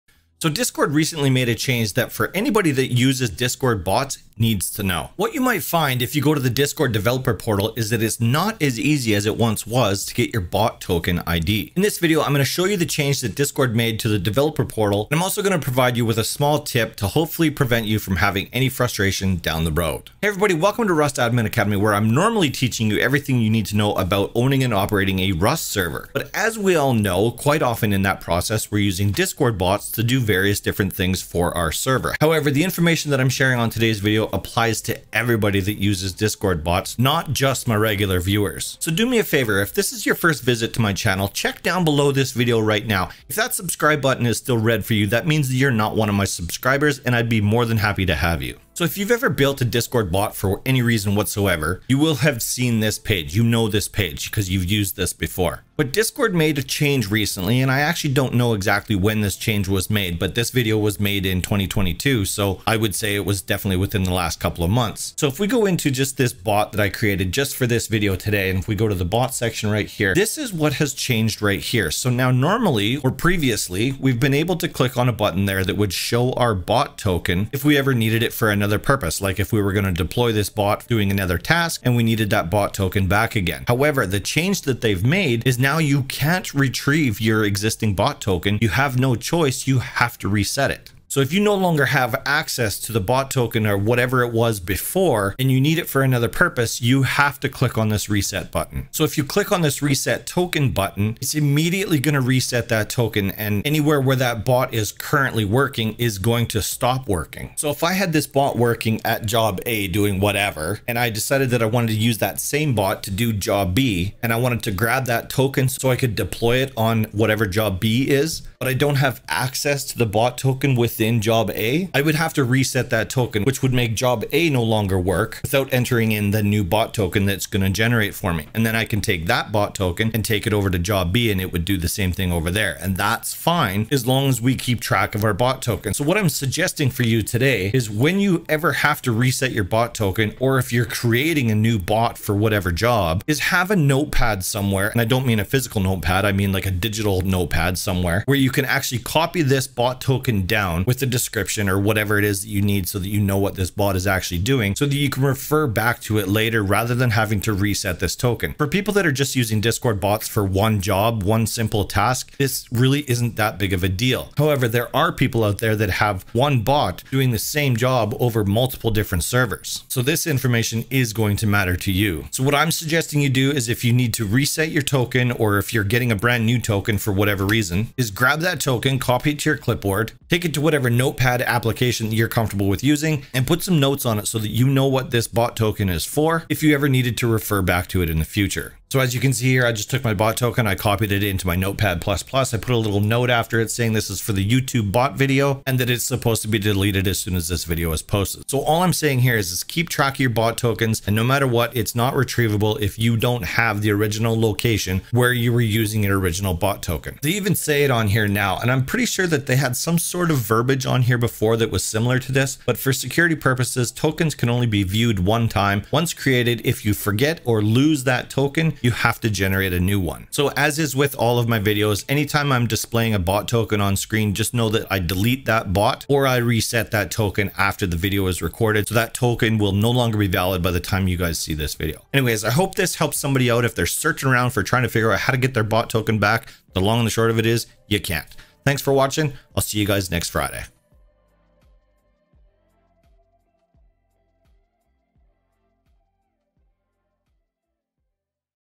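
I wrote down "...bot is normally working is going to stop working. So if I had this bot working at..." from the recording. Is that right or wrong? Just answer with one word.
wrong.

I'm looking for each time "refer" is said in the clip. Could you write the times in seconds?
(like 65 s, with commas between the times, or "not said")
155 s, 187 s.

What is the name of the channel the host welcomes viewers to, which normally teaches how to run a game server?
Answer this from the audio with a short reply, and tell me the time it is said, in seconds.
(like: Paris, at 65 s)
Rust Admin Academy, at 20 s.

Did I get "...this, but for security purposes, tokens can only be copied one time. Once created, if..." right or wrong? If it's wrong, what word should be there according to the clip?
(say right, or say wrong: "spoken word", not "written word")
wrong: "viewed", not "copied".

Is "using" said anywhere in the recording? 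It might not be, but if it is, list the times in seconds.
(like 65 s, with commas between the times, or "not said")
28 s, 159 s, 182 s, 205 s.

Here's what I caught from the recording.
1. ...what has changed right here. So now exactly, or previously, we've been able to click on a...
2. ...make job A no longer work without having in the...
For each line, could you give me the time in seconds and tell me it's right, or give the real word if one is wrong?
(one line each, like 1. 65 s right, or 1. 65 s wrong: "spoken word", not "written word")
1. 70 s wrong: "normally", not "exactly"
2. 123 s wrong: "entering", not "having".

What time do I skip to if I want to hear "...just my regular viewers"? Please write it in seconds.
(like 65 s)
37 s.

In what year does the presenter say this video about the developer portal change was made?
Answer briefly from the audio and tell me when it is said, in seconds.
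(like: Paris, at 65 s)
2022, at 61 s.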